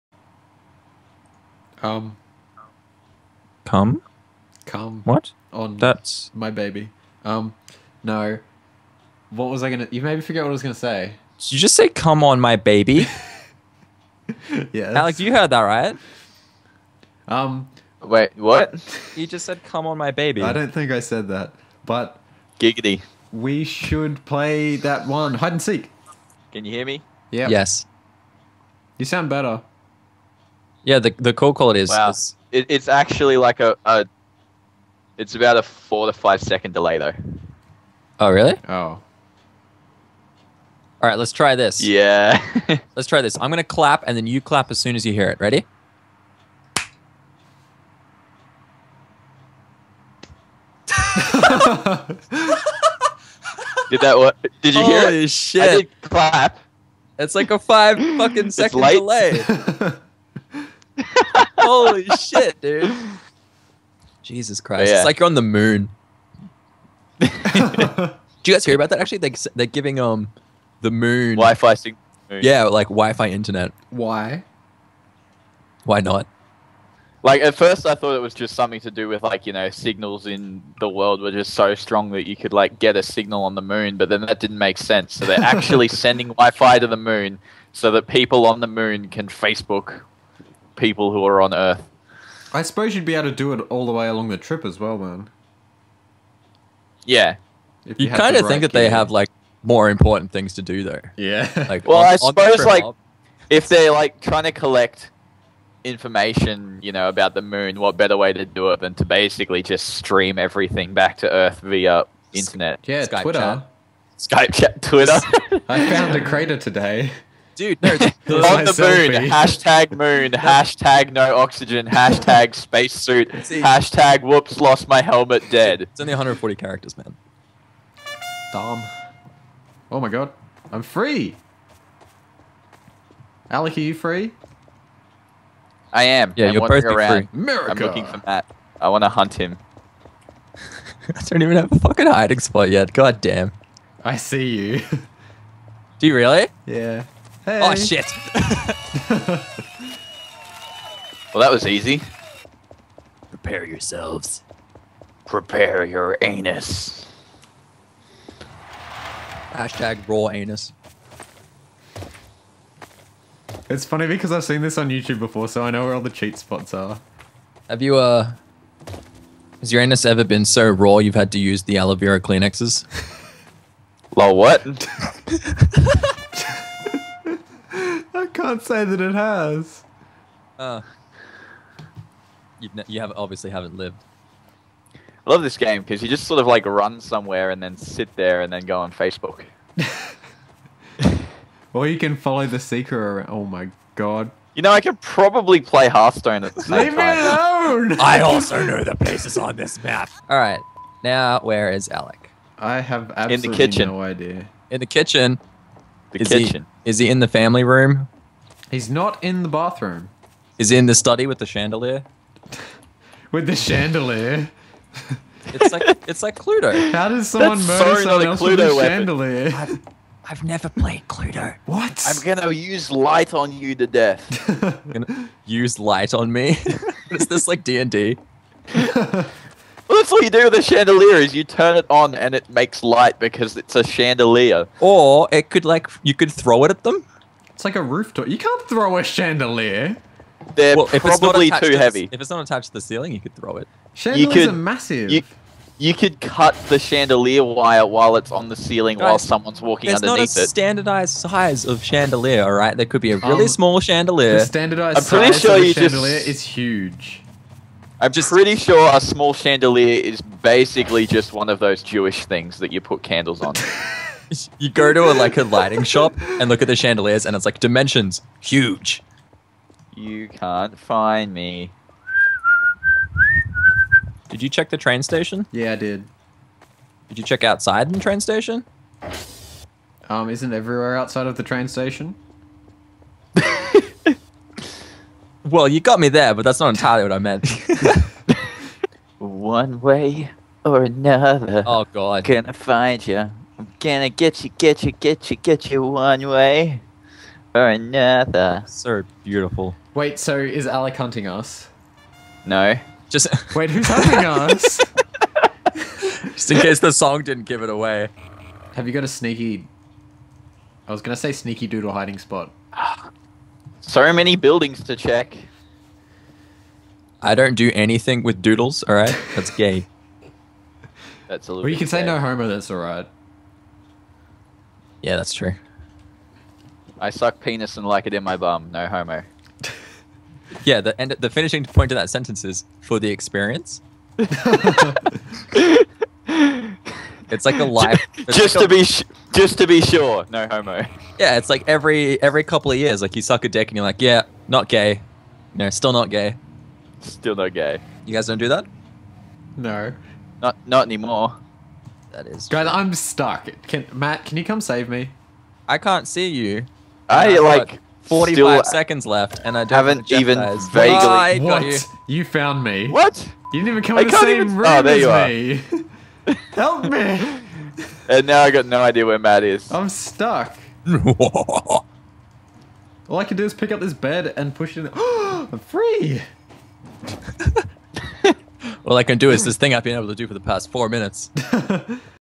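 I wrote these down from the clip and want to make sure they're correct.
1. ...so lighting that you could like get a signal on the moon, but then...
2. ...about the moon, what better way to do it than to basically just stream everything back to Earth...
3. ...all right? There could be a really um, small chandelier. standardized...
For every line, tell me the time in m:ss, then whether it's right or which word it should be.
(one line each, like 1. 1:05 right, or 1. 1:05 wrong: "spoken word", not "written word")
1. 1:21 wrong: "strong", not "lighting"
2. 1:47 right
3. 4:12 right.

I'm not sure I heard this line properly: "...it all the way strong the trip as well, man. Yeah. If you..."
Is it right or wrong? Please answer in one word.
wrong.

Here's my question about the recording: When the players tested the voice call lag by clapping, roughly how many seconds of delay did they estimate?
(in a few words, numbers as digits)
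4 to 5 seconds.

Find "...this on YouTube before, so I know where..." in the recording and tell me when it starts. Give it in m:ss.
2:44.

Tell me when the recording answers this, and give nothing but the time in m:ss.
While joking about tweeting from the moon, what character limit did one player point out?
2:06.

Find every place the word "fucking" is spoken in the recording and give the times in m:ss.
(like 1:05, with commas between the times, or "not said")
0:58, 2:21.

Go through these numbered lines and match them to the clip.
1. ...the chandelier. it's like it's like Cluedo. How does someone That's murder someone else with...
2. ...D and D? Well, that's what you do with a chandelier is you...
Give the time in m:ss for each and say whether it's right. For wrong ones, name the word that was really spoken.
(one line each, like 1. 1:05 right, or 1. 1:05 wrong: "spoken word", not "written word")
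1. 3:33 right
2. 3:47 right.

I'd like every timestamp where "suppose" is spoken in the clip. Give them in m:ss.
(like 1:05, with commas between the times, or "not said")
1:32, 1:42.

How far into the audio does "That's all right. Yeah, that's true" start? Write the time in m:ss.
5:22.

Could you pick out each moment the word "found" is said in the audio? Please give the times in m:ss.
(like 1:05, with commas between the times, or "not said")
1:55, 6:02.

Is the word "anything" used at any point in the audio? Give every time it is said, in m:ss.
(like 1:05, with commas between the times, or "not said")
5:17.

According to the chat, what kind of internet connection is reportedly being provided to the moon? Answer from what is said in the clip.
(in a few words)
Wi-Fi.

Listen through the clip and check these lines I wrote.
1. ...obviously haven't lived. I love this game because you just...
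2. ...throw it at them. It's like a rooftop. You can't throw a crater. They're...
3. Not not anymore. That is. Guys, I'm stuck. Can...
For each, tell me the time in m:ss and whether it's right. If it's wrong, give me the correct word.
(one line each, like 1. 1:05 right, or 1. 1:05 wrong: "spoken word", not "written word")
1. 3:03 right
2. 3:56 wrong: "chandelier", not "crater"
3. 5:50 right.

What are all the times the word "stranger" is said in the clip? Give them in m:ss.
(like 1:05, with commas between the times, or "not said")
not said.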